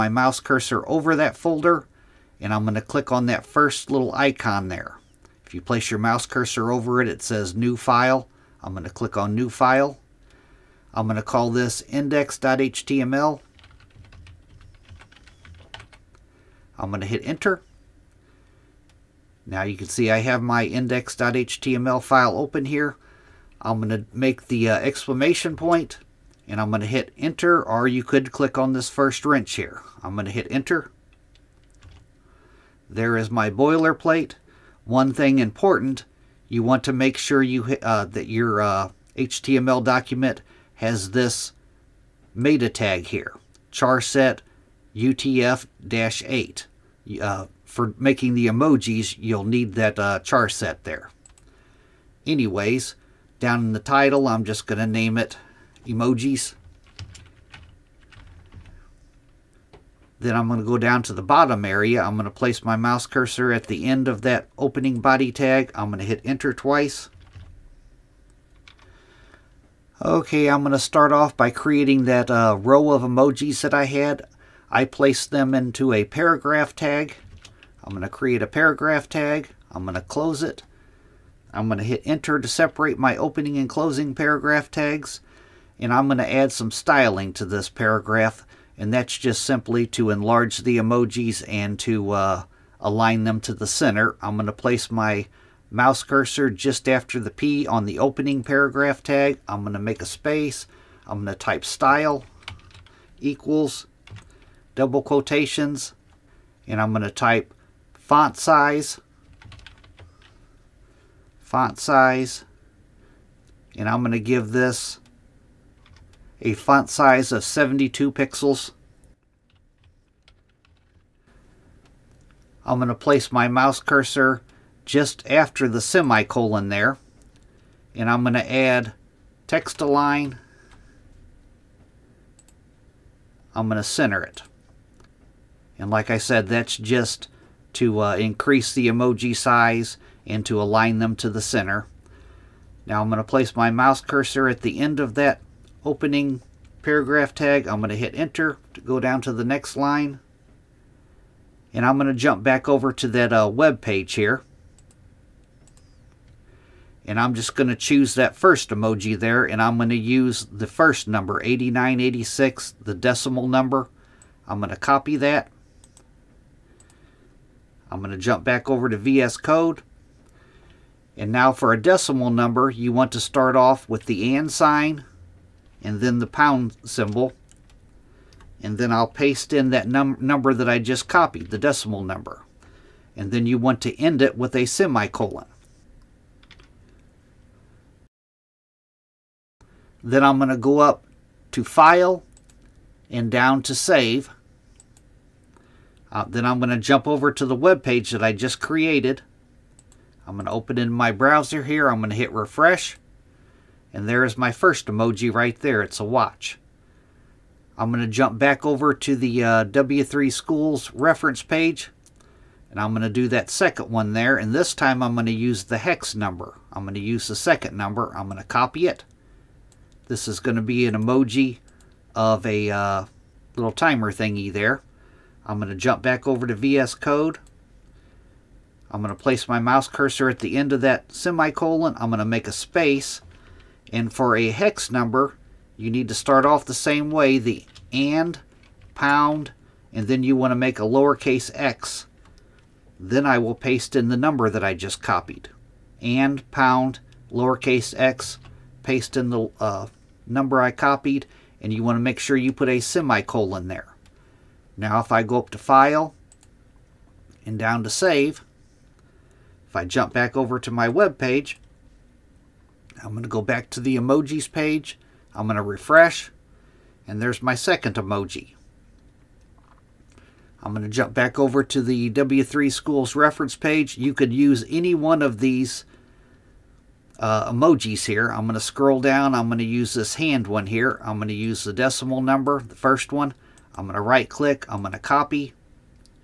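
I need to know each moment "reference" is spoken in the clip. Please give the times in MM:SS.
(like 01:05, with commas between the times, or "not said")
03:30, 04:33.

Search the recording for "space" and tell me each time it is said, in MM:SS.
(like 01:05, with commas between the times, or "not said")
01:40, 03:52.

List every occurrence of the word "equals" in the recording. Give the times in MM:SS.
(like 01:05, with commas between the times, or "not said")
01:43.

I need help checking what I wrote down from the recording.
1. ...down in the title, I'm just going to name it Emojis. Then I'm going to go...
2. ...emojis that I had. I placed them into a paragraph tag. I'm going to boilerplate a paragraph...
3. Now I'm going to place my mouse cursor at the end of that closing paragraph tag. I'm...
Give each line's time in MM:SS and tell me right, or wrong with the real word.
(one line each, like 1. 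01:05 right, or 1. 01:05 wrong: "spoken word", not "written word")
1. 00:53 right
2. 01:13 wrong: "create", not "boilerplate"
3. 02:22 wrong: "opening", not "closing".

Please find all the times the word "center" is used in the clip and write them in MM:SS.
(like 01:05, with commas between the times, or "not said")
01:33, 02:13, 02:21.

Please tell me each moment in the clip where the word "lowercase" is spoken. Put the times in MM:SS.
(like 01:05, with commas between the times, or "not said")
04:00, 04:07.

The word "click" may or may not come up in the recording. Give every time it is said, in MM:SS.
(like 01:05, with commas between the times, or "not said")
00:02, 00:08, 00:28, 04:44.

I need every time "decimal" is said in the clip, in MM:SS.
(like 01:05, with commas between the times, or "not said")
02:42, 02:51, 03:01, 04:41.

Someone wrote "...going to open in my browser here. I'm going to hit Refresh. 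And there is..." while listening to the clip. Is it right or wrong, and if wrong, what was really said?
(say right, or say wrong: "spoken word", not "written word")
right.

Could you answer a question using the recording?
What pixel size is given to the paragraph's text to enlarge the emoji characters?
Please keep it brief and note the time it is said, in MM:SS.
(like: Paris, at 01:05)
72 pixels, at 01:57.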